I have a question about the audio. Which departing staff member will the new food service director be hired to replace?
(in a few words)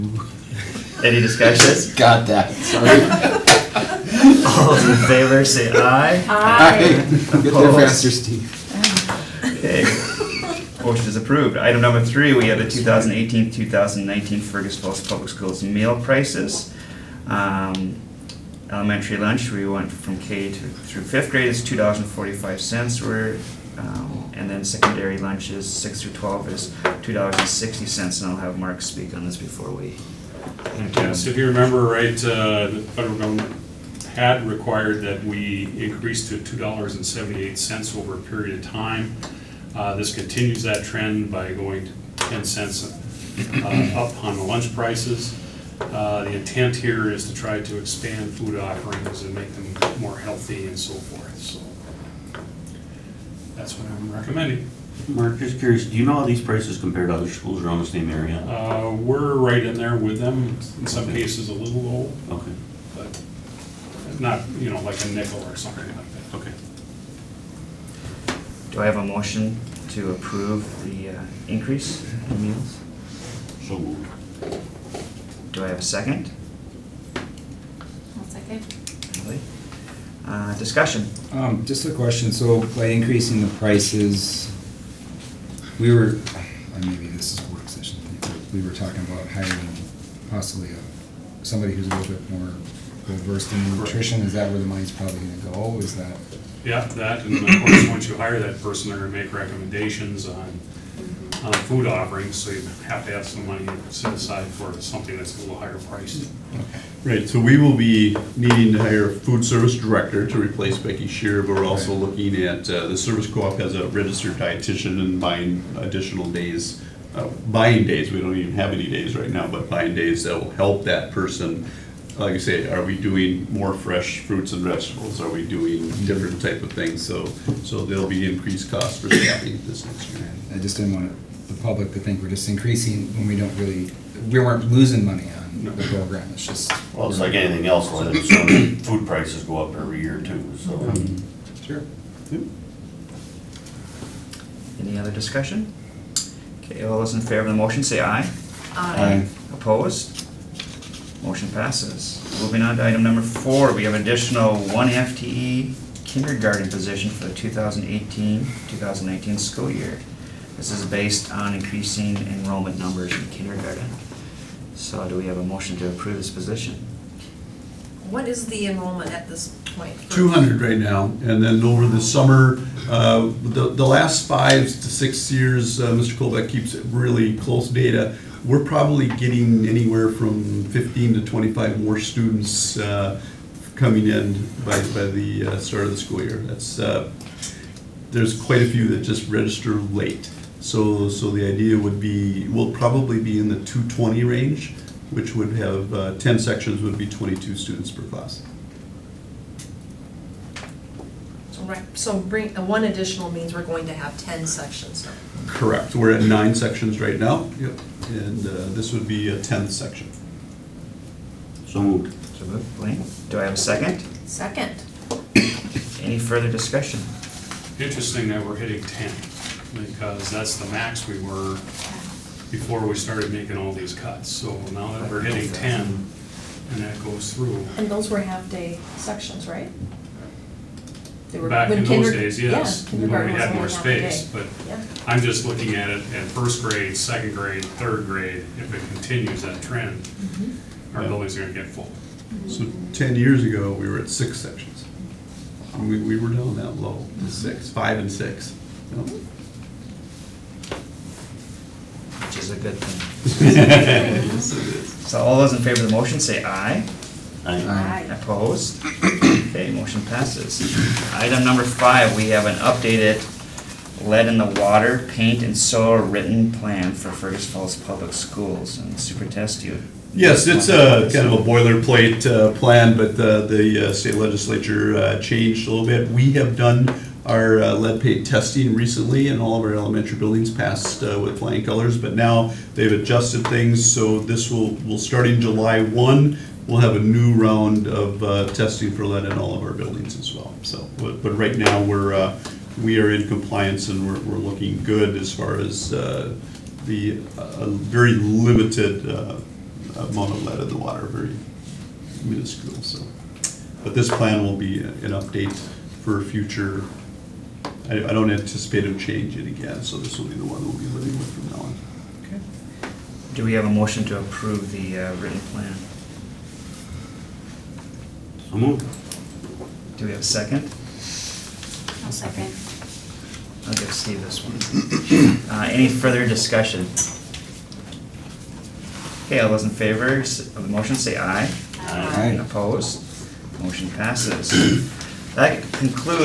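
Becky Shear.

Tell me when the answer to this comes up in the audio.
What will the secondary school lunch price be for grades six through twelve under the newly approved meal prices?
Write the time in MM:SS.
00:27.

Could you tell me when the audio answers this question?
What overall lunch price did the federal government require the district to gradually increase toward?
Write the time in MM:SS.
00:36.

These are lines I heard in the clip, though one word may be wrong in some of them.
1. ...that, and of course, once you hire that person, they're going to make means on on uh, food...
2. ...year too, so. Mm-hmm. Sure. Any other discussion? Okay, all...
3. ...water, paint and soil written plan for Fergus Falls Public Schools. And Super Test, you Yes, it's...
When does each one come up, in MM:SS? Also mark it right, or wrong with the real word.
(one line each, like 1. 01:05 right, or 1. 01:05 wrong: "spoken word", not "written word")
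1. 01:36 wrong: "recommendations", not "means"
2. 02:20 right
3. 04:24 right.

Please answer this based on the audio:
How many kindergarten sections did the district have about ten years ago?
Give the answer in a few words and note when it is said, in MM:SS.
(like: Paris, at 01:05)
6, at 04:04.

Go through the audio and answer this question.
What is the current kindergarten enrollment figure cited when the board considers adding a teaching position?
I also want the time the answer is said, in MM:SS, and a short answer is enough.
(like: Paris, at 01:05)
200, at 02:50.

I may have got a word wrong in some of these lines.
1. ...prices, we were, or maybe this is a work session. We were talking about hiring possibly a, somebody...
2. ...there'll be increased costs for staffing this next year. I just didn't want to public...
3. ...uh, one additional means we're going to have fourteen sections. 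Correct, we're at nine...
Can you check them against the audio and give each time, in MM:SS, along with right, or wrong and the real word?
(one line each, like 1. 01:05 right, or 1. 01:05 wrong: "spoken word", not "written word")
1. 01:23 right
2. 02:07 right
3. 03:22 wrong: "ten", not "fourteen".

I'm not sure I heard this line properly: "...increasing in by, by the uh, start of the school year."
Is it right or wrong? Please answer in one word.
wrong.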